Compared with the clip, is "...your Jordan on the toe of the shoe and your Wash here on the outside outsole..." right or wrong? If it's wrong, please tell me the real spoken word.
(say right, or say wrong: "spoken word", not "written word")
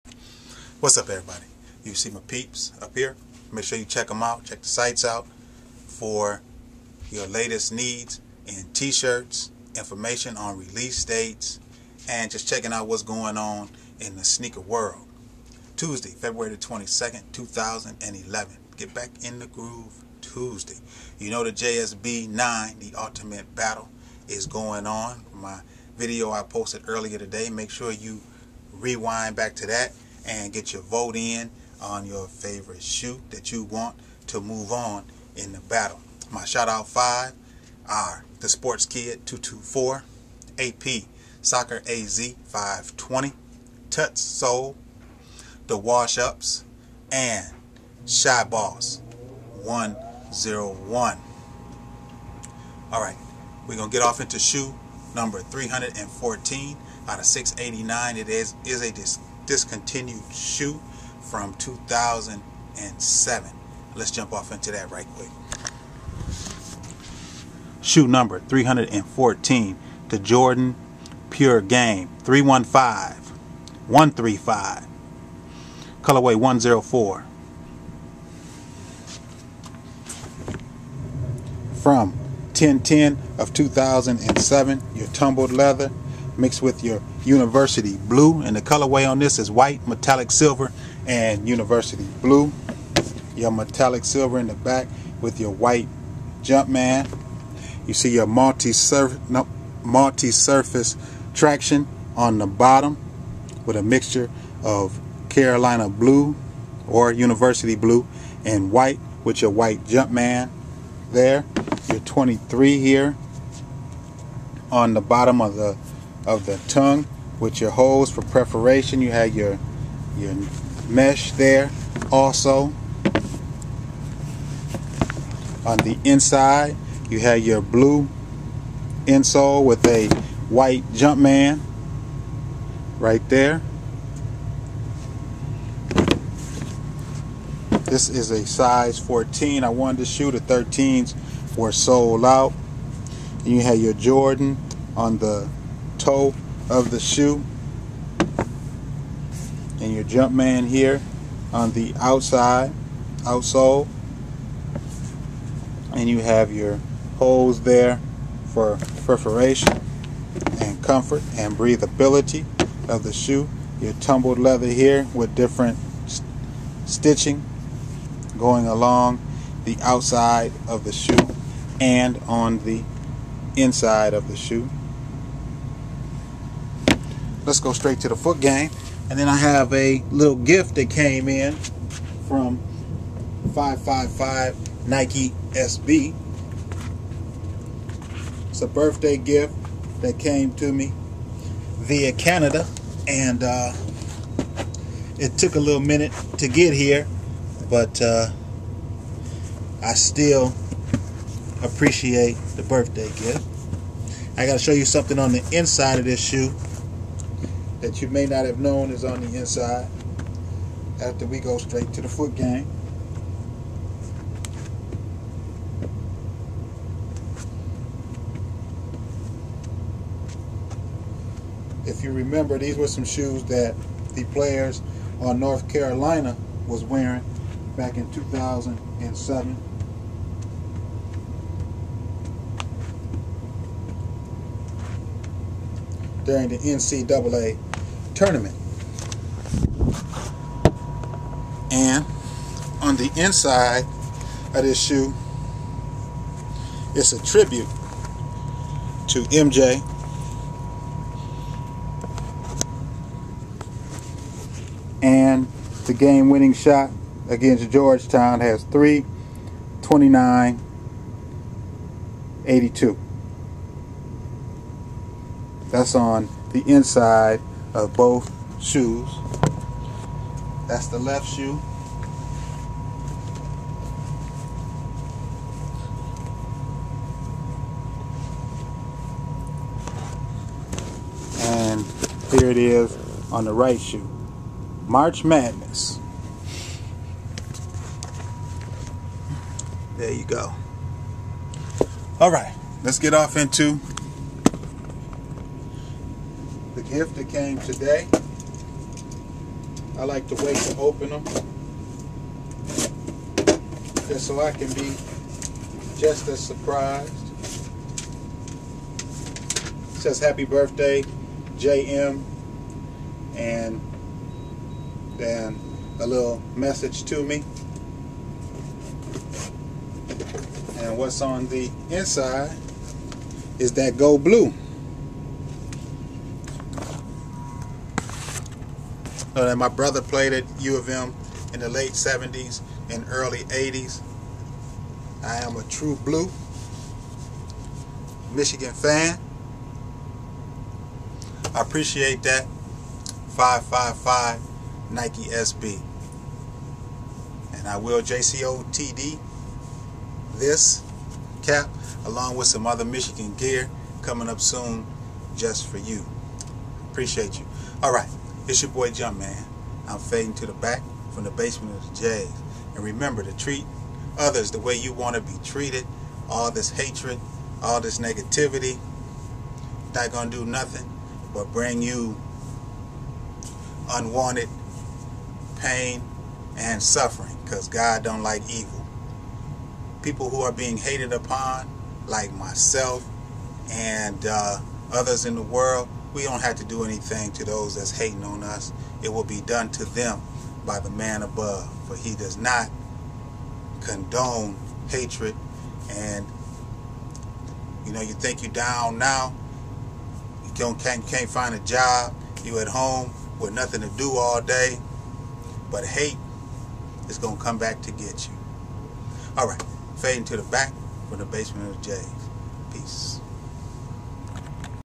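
wrong: "Jumpman", not "Wash".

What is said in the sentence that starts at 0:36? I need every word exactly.
My shout out five are the Sports Kid 224, AP Soccer AZ 520, Tuts Soul, The Wash Ups, and Shy Boss 101.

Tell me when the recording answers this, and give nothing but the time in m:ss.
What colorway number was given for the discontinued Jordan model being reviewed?
1:16.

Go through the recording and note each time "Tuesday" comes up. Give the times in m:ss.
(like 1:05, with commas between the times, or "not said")
0:15, 0:20.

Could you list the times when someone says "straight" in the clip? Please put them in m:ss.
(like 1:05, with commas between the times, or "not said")
2:57, 3:31.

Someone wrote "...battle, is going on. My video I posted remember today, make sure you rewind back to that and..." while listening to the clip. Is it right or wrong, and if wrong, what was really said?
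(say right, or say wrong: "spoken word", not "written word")
wrong: "earlier", not "remember".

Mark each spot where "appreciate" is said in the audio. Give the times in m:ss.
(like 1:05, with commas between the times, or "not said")
3:21, 5:41, 5:56.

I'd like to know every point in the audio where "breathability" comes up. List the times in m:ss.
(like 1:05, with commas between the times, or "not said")
2:41.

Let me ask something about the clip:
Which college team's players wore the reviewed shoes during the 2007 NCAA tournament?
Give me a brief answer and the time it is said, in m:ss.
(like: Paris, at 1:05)
North Carolina, at 3:45.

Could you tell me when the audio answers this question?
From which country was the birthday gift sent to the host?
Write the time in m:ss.
3:12.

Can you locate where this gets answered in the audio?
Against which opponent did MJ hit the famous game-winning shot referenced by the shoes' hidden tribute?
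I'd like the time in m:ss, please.
4:17.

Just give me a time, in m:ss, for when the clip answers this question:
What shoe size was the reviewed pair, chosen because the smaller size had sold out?
2:18.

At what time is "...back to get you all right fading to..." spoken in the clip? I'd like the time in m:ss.
6:47.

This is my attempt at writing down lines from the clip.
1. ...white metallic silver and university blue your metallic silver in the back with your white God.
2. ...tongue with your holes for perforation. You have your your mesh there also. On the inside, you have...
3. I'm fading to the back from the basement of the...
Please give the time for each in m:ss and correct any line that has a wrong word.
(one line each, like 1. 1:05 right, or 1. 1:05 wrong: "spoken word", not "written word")
1. 1:29 wrong: "Jumpman", not "God"
2. 1:56 wrong: "preparation", not "perforation"
3. 5:59 right.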